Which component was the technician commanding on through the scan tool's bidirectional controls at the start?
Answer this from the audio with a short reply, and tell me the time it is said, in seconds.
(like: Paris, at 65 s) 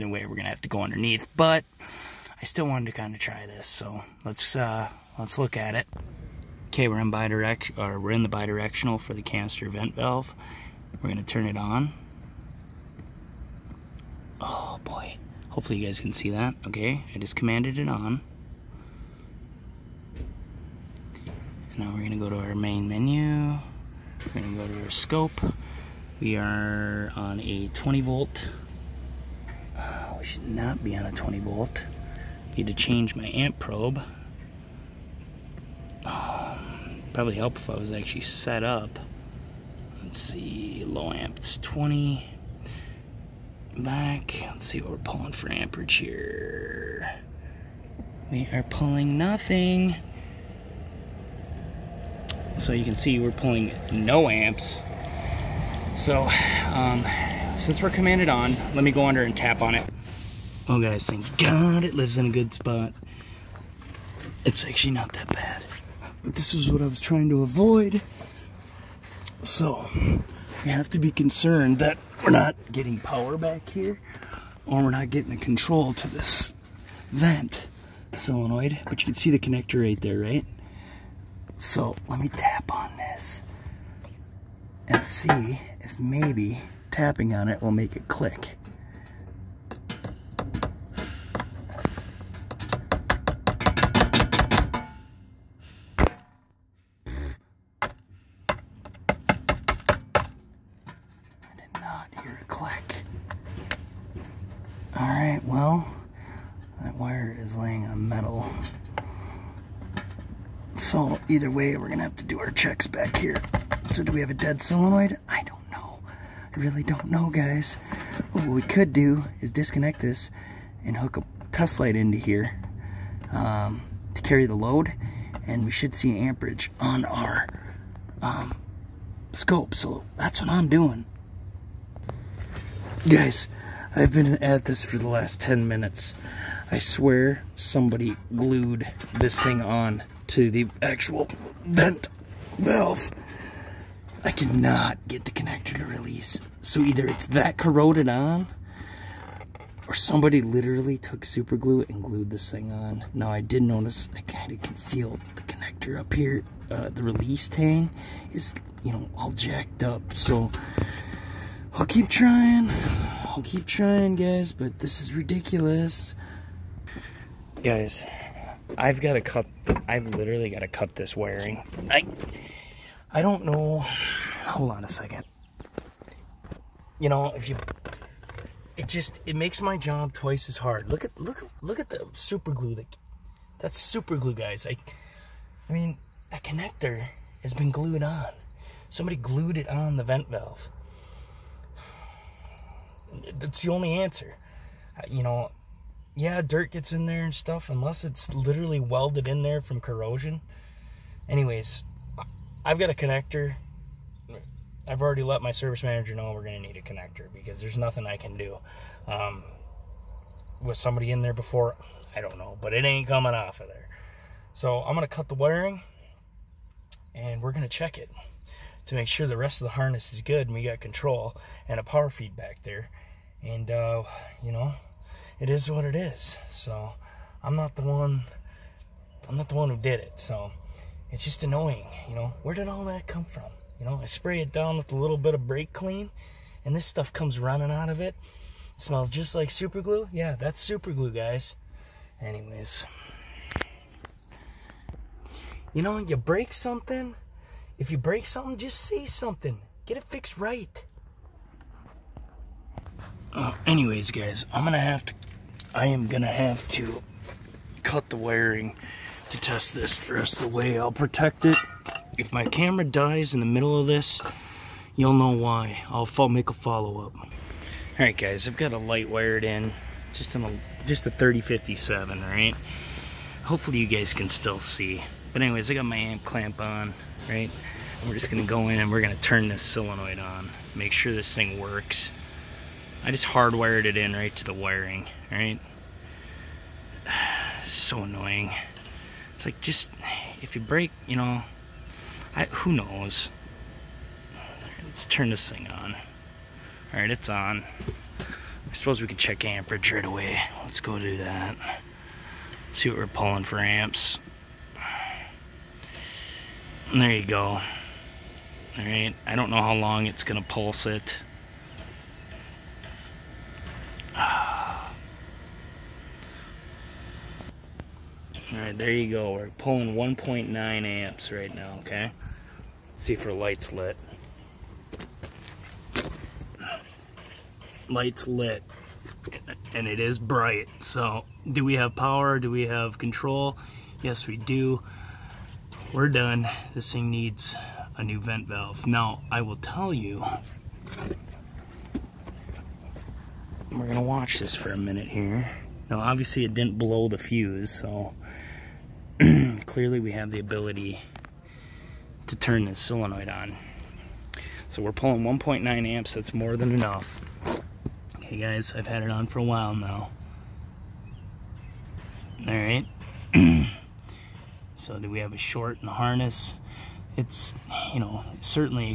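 canister vent valve, at 9 s.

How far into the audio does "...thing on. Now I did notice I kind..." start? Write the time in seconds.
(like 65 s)
152 s.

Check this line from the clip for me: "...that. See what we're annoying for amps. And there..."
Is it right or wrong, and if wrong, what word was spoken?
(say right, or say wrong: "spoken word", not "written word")
wrong: "pulling", not "annoying".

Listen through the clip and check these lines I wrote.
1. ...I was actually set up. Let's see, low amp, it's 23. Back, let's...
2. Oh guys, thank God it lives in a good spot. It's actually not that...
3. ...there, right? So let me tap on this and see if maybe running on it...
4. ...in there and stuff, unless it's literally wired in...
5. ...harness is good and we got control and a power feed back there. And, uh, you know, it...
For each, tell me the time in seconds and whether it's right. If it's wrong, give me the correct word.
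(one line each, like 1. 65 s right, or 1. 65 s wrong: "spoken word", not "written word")
1. 37 s wrong: "20", not "23"
2. 60 s right
3. 80 s wrong: "tapping", not "running"
4. 196 s wrong: "welded", not "wired"
5. 219 s right.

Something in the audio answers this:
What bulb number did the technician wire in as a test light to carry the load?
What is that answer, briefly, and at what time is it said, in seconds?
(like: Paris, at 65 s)
3057, at 271 s.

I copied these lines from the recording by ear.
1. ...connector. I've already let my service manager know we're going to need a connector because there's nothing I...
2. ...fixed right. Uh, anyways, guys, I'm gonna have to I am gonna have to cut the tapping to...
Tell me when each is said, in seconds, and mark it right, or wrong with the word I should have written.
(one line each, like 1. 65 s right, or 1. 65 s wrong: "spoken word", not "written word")
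1. 202 s right
2. 250 s wrong: "wiring", not "tapping".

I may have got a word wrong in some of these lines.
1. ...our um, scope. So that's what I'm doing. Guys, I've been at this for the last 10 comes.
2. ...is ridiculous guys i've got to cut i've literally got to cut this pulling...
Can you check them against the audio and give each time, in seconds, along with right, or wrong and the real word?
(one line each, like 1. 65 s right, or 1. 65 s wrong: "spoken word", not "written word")
1. 127 s wrong: "minutes", not "comes"
2. 165 s wrong: "wiring", not "pulling".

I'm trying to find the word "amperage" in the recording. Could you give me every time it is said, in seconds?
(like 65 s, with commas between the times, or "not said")
45 s, 126 s, 299 s.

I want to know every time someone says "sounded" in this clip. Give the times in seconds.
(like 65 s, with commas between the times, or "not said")
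not said.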